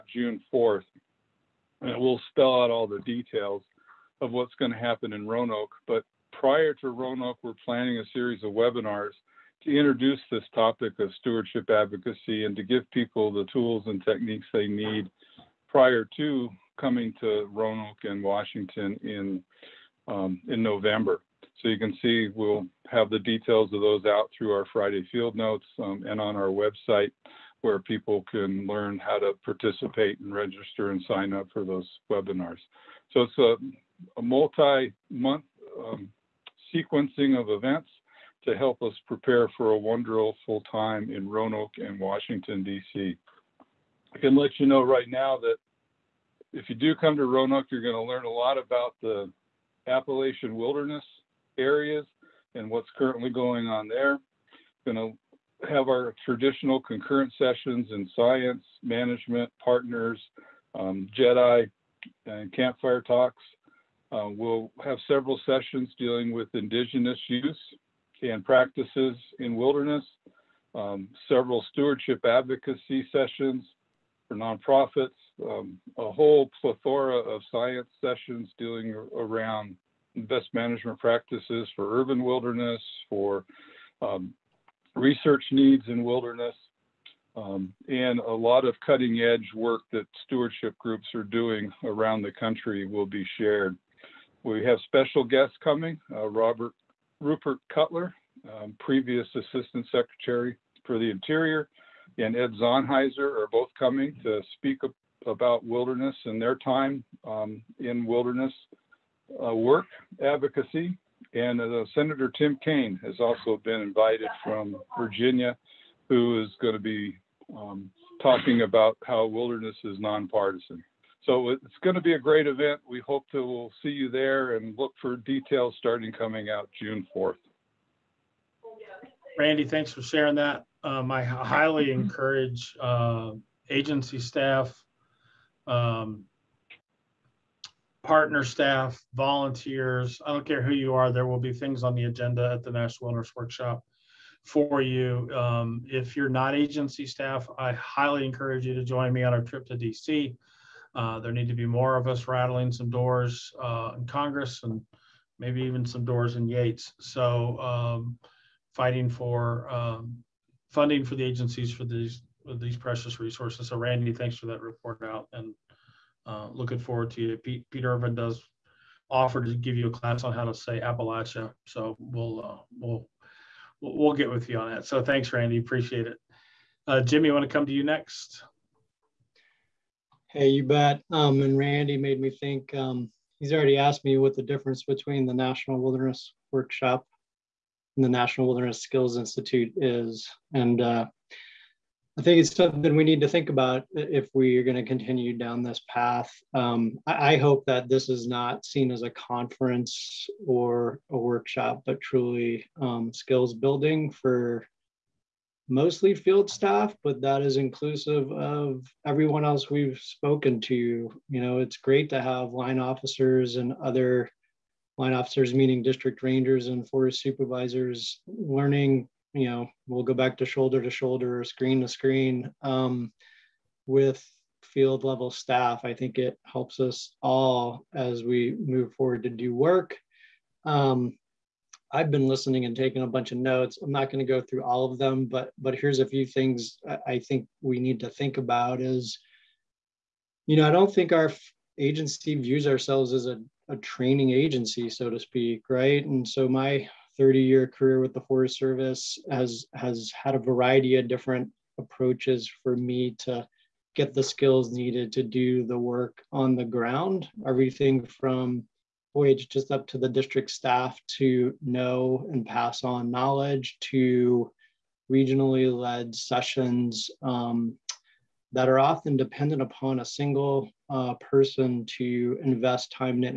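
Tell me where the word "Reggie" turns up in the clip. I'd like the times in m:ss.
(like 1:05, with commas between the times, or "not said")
not said.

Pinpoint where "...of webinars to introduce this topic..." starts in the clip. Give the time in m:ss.
0:08.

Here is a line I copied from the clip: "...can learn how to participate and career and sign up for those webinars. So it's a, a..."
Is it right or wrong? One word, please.
wrong.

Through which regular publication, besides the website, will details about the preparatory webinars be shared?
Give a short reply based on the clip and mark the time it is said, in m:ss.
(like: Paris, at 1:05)
Friday field notes, at 0:24.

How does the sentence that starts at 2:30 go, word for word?
Uh, there need to be more of us rattling some doors uh, in Congress and maybe even some doors in Yates.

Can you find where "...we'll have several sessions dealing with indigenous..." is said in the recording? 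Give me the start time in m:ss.
1:04.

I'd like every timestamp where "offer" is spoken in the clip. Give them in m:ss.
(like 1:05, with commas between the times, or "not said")
2:49.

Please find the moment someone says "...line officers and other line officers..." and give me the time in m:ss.
3:32.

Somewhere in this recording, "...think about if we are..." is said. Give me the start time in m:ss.
3:13.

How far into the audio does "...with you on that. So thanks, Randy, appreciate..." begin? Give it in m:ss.
2:54.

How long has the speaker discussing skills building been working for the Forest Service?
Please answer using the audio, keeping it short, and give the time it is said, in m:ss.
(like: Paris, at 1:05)
30 years, at 4:07.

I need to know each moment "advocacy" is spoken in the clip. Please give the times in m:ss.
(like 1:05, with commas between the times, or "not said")
0:11, 1:12, 1:50.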